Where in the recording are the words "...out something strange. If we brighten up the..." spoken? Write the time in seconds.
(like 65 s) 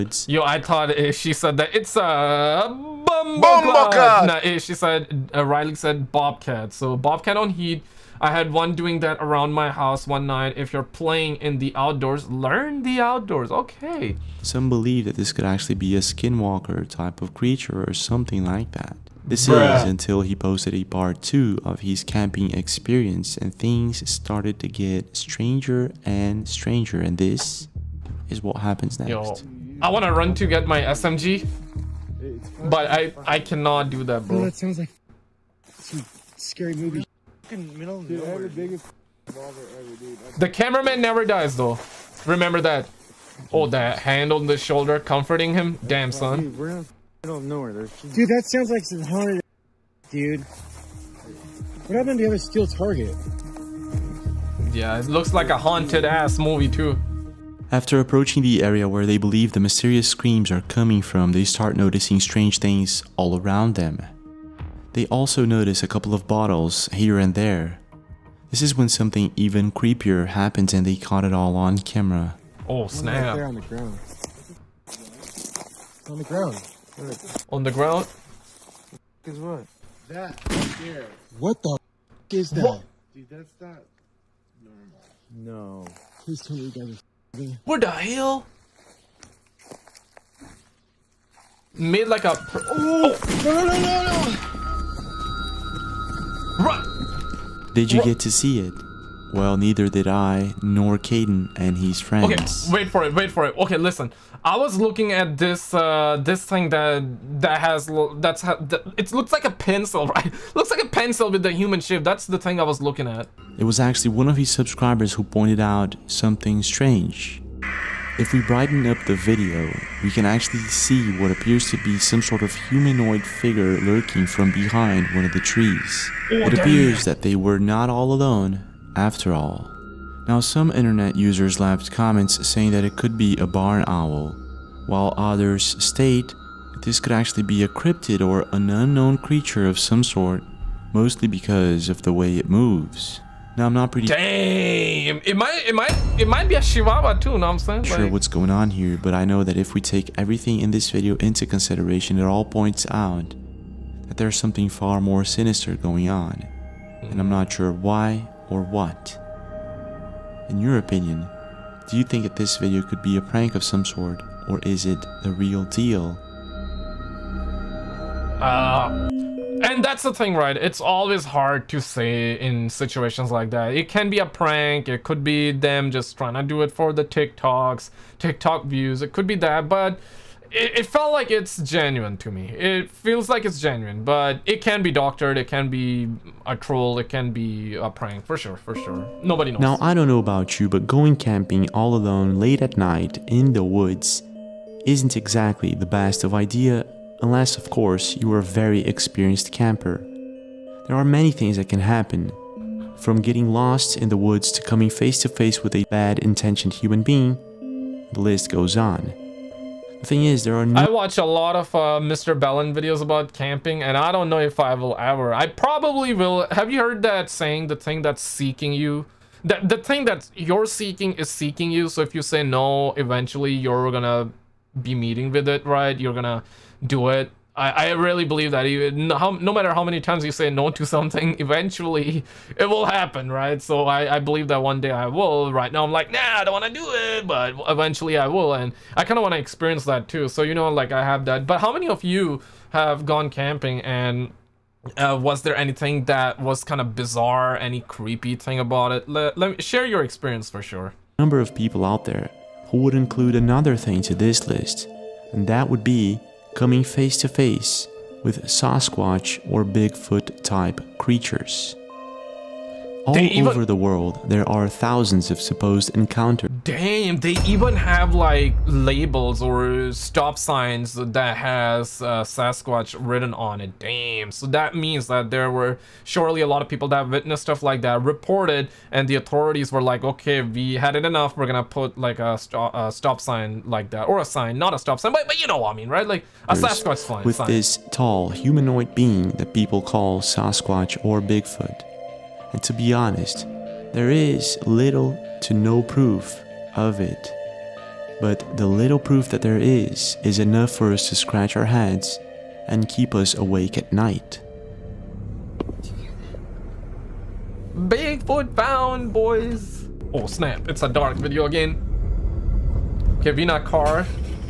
115 s.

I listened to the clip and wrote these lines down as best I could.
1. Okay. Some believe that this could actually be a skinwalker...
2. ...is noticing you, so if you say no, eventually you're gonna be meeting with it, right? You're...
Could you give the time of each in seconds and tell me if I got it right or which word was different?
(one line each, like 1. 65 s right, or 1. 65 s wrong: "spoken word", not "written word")
1. 13 s right
2. 221 s wrong: "seeking", not "noticing".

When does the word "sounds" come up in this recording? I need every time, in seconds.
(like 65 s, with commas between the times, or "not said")
34 s, 48 s.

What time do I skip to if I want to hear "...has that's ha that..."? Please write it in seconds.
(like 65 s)
107 s.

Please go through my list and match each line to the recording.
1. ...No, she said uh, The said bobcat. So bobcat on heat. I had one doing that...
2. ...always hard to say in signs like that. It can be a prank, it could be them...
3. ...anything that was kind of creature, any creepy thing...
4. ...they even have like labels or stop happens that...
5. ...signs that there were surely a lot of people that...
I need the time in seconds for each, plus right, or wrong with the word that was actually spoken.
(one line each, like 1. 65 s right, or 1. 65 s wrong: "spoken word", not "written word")
1. 4 s wrong: "Riley", not "The"
2. 170 s wrong: "situations", not "signs"
3. 245 s wrong: "bizarre", not "creature"
4. 267 s wrong: "signs", not "happens"
5. 274 s wrong: "means", not "signs".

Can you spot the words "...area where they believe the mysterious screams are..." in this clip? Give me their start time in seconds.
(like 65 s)
58 s.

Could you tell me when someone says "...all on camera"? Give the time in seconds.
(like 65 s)
71 s.